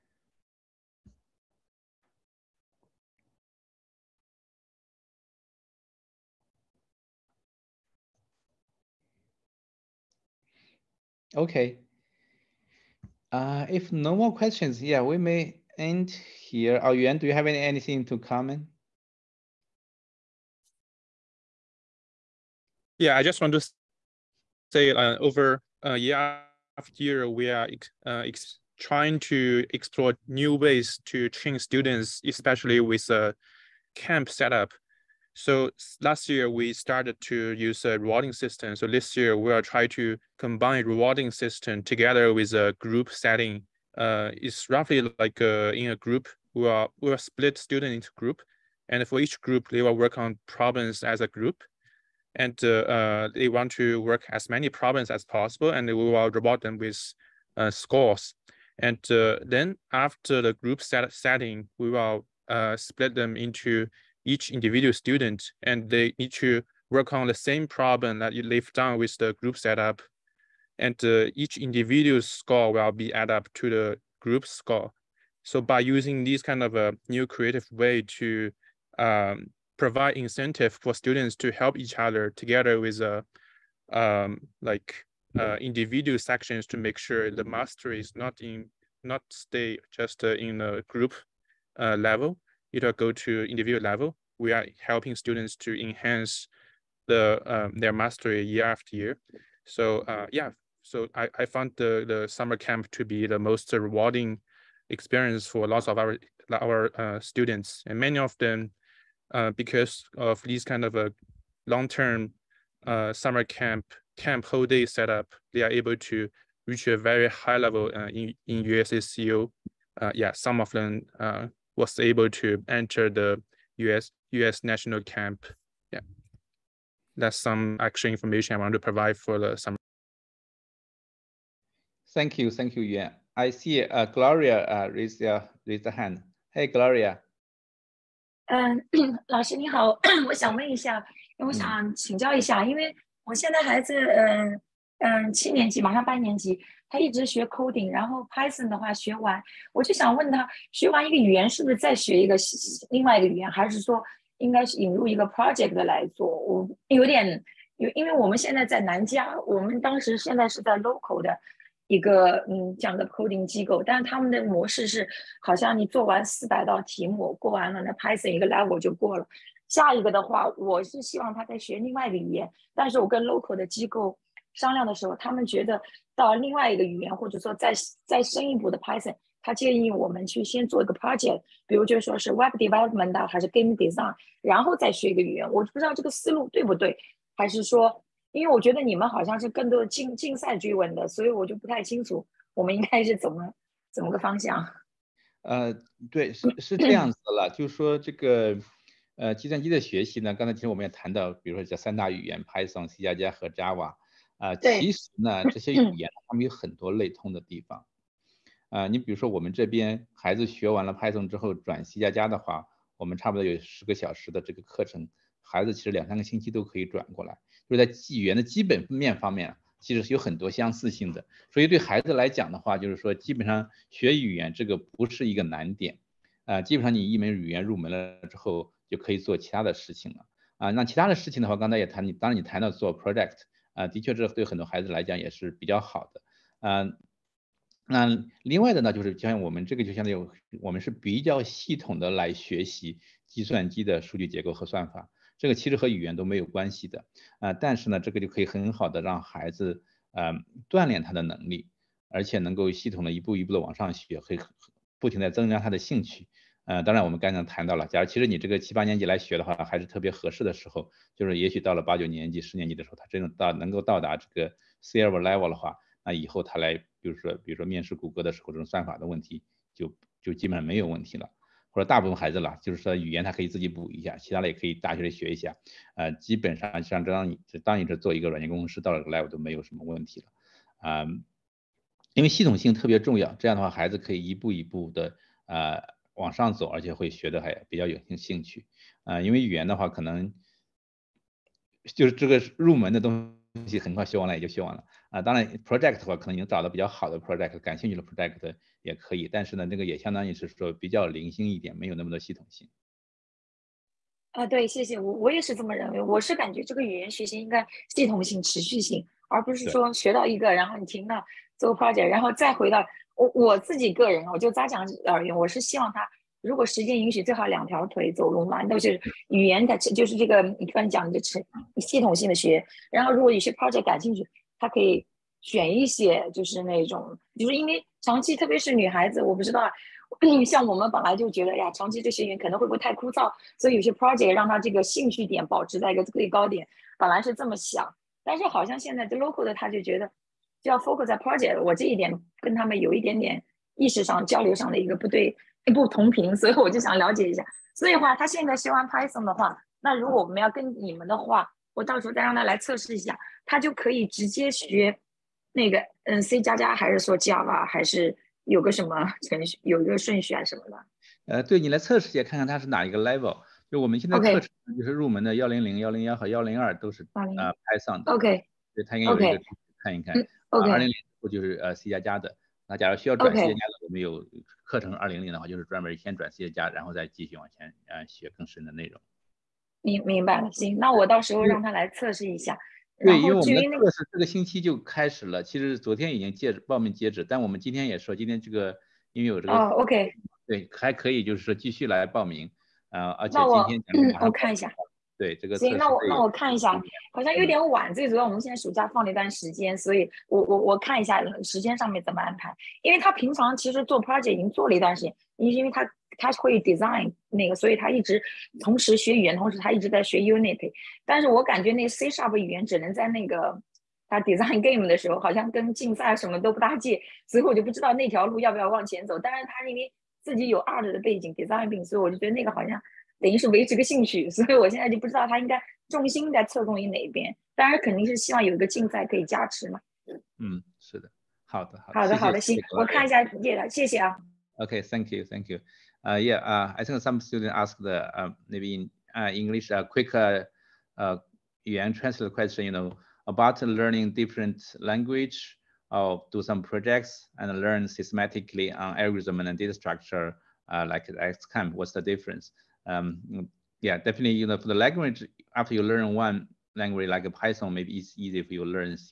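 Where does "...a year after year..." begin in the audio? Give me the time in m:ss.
0:25.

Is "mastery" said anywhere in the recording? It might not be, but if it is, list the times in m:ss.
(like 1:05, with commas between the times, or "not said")
1:27, 1:37.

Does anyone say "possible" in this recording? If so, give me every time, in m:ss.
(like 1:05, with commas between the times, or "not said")
0:55.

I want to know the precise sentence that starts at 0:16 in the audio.
Oh, Yuan, do you have any, anything to comment?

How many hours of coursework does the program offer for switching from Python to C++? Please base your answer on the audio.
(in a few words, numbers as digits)
10.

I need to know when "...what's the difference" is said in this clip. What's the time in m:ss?
7:31.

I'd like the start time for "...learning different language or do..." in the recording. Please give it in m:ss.
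7:23.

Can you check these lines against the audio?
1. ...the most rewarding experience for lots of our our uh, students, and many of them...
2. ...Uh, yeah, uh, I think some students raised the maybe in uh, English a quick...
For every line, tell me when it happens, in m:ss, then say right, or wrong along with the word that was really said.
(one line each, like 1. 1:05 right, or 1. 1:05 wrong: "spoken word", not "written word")
1. 1:43 right
2. 7:16 wrong: "asked", not "raised".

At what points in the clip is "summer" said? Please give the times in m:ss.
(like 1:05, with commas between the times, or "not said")
1:42, 1:53, 2:09.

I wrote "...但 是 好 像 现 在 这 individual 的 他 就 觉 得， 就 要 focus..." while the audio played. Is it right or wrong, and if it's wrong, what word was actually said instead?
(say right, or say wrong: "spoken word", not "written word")
wrong: "local", not "individual".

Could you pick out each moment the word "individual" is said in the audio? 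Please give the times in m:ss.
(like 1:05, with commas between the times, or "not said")
1:04, 1:11, 1:25, 1:33.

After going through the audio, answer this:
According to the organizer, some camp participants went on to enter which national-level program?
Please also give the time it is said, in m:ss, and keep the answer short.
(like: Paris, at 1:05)
US national camp, at 2:03.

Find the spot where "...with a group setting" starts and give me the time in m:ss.
0:42.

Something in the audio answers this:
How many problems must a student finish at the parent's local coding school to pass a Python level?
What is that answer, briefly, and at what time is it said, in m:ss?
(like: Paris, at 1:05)
400, at 2:46.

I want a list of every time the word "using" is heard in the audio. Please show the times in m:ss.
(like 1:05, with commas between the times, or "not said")
1:15.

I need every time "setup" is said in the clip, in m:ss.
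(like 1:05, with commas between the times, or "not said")
0:34, 1:09, 1:54.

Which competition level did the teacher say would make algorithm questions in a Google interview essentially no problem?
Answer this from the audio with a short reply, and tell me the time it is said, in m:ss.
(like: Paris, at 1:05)
silver level, at 4:24.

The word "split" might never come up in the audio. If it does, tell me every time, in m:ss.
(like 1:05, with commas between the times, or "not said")
0:47, 1:02.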